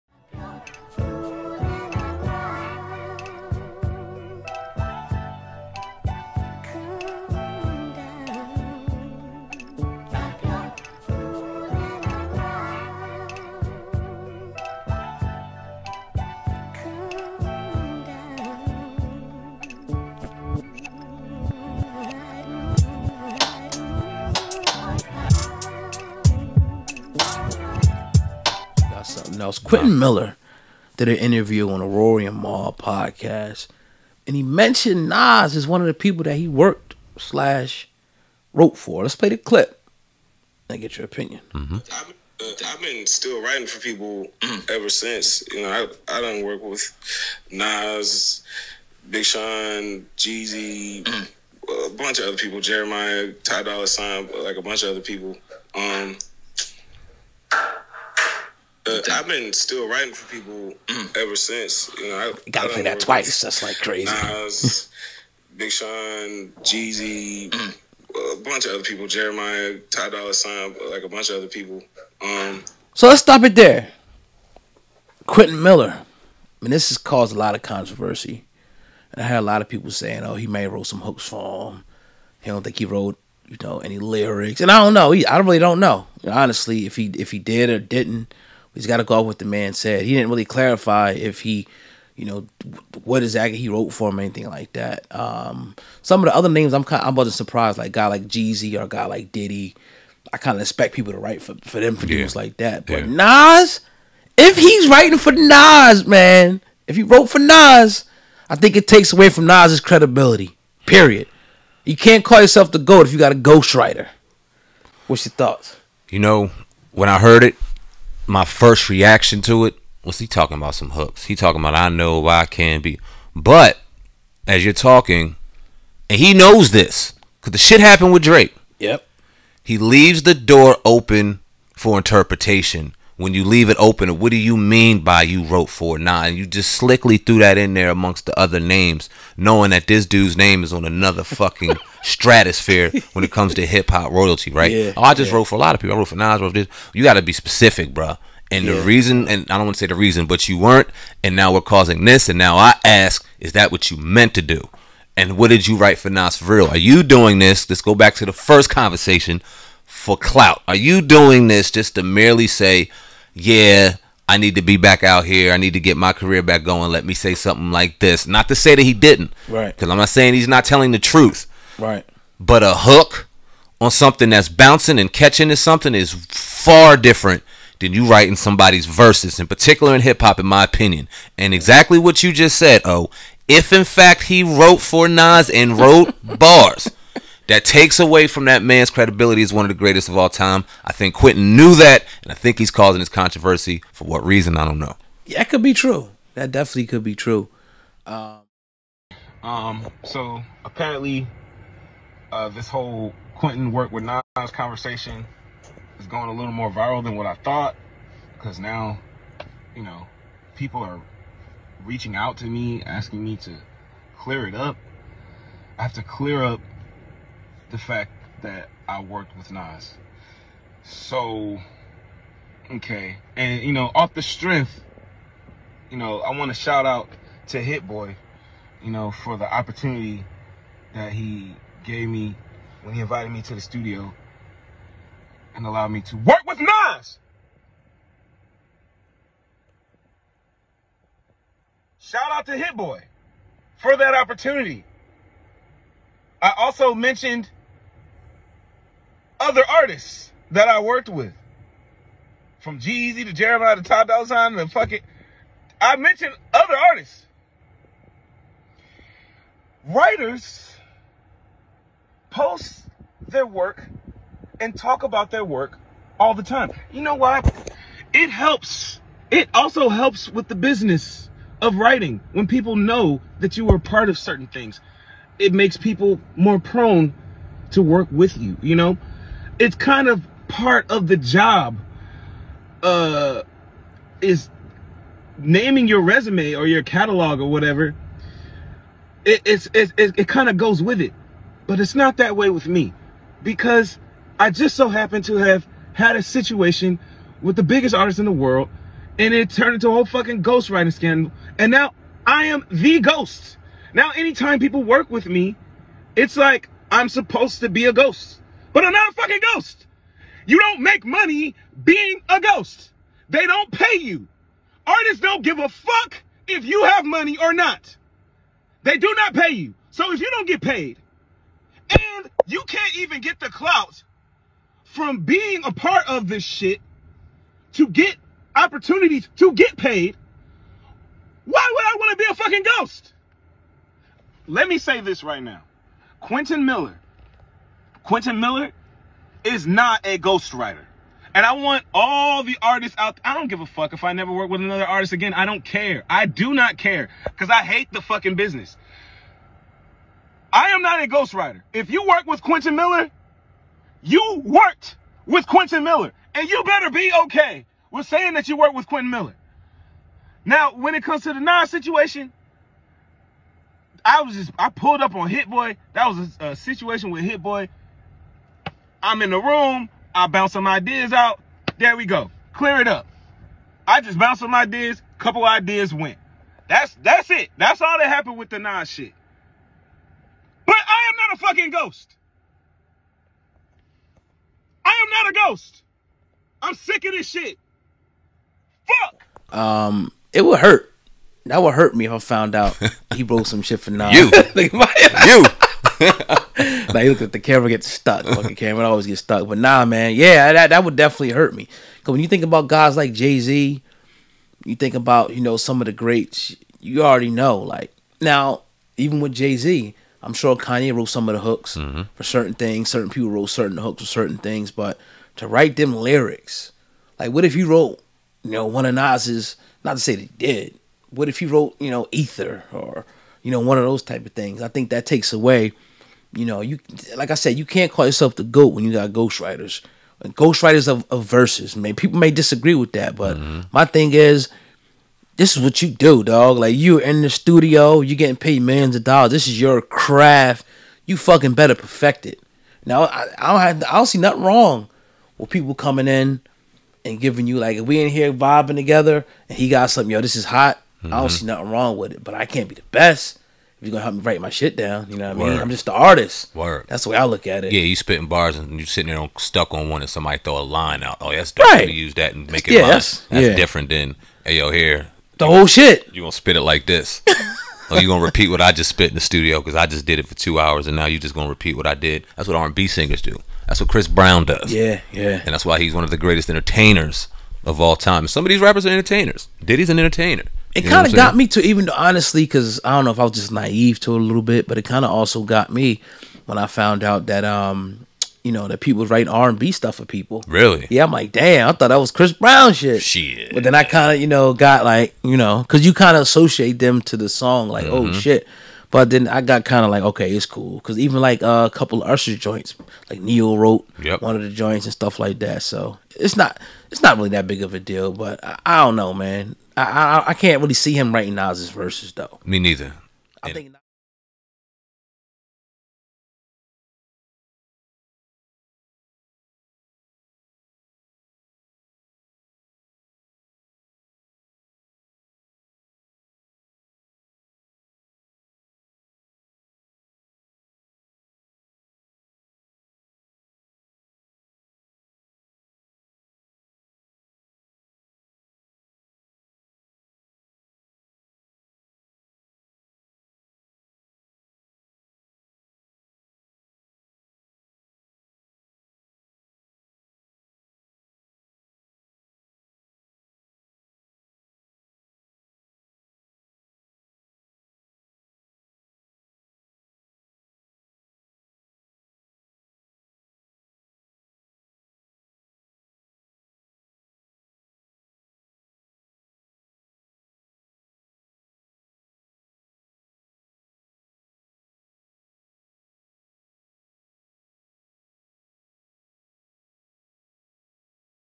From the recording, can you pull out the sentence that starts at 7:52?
That's what R and B singers do.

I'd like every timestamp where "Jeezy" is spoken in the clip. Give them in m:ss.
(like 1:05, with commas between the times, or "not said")
0:50, 1:06, 1:38, 4:12.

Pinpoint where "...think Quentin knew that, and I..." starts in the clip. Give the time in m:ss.
3:10.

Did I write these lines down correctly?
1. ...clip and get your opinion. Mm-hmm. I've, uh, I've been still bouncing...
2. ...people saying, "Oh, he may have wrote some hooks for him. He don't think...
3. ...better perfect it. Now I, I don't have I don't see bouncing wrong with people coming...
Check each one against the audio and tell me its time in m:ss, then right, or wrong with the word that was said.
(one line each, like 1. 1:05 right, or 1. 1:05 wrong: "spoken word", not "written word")
1. 0:39 wrong: "writing", not "bouncing"
2. 1:19 right
3. 7:21 wrong: "nothing", not "bouncing".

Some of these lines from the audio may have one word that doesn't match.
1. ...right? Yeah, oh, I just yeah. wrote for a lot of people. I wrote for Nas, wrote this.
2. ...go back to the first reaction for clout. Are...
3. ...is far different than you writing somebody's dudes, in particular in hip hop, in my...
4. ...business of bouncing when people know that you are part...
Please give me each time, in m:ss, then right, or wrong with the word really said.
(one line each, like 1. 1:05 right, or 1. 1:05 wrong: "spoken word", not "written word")
1. 2:24 right
2. 2:37 wrong: "conversation", not "reaction"
3. 2:55 wrong: "verses", not "dudes"
4. 4:30 wrong: "writing", not "bouncing".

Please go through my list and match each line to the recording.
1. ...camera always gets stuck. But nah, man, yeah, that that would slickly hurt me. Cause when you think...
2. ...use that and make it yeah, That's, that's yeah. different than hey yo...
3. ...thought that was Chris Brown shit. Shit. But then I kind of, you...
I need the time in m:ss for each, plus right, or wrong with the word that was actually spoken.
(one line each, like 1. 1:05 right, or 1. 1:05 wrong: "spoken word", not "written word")
1. 6:38 wrong: "definitely", not "slickly"
2. 7:41 right
3. 8:11 right.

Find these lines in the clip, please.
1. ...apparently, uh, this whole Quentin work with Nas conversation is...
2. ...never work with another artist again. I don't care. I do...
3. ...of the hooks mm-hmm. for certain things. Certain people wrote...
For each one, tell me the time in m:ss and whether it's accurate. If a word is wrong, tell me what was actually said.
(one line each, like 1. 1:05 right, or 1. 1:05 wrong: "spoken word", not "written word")
1. 3:20 right
2. 5:44 right
3. 6:51 right.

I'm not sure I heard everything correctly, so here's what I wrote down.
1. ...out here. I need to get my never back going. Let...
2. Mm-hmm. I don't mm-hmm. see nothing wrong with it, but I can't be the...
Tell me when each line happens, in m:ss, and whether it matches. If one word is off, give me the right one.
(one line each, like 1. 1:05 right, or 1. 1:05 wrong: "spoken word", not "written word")
1. 2:45 wrong: "career", not "never"
2. 7:30 right.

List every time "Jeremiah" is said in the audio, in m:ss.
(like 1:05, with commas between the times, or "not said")
0:52, 1:09, 4:13.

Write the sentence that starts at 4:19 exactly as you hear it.
Writers post their work and talk about their work all the time.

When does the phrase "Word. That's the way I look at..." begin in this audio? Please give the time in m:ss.
7:36.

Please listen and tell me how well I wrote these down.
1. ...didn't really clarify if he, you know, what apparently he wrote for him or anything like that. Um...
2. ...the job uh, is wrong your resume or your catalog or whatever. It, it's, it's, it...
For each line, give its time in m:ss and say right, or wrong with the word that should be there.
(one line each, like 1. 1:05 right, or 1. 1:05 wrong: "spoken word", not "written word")
1. 1:30 wrong: "exactly", not "apparently"
2. 4:41 wrong: "naming", not "wrong".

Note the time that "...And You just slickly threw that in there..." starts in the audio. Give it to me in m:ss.
2:15.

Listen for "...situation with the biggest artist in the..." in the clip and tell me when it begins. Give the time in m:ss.
4:56.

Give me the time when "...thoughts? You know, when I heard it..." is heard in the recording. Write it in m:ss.
1:55.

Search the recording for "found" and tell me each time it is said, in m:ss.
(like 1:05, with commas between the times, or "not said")
6:32, 8:06.